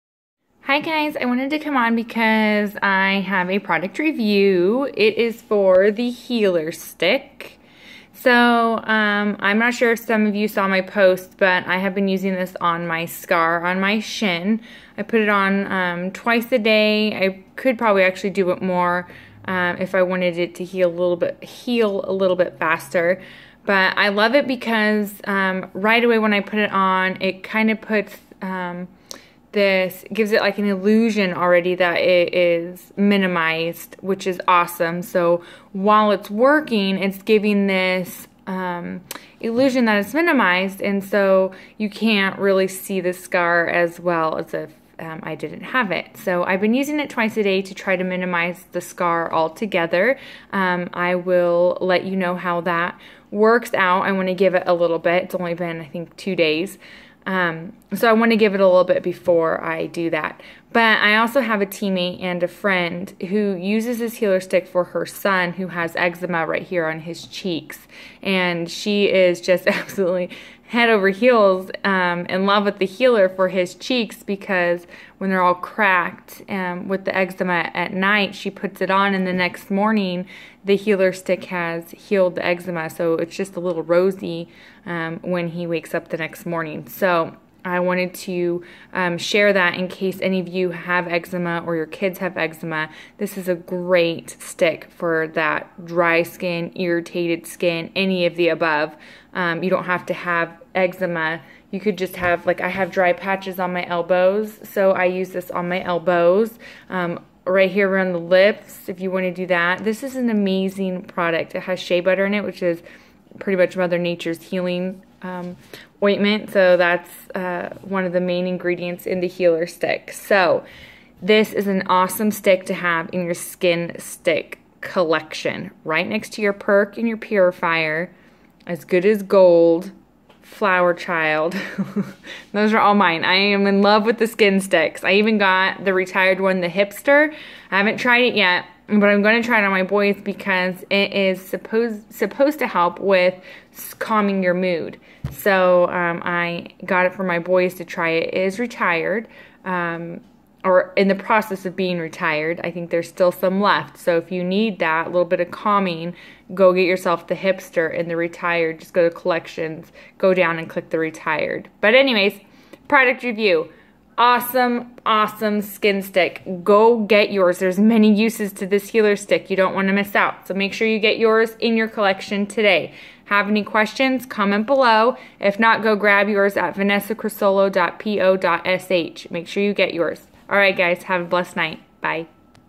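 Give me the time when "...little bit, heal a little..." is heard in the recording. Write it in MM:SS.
00:20.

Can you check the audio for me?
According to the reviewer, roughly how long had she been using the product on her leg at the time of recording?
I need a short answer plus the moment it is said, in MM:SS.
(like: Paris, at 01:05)
2 days, at 00:56.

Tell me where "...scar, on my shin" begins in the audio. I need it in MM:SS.
00:13.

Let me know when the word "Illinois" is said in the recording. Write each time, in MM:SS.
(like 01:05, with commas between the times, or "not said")
not said.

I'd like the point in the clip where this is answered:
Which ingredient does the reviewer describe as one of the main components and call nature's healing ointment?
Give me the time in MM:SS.
01:51.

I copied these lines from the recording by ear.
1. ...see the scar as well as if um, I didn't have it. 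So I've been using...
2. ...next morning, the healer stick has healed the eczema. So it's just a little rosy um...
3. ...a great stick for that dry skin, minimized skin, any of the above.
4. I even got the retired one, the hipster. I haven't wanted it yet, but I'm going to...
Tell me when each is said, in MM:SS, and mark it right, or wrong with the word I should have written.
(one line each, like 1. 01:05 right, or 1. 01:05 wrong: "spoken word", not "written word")
1. 00:42 right
2. 01:19 right
3. 01:33 wrong: "irritated", not "minimized"
4. 02:15 wrong: "tried", not "wanted".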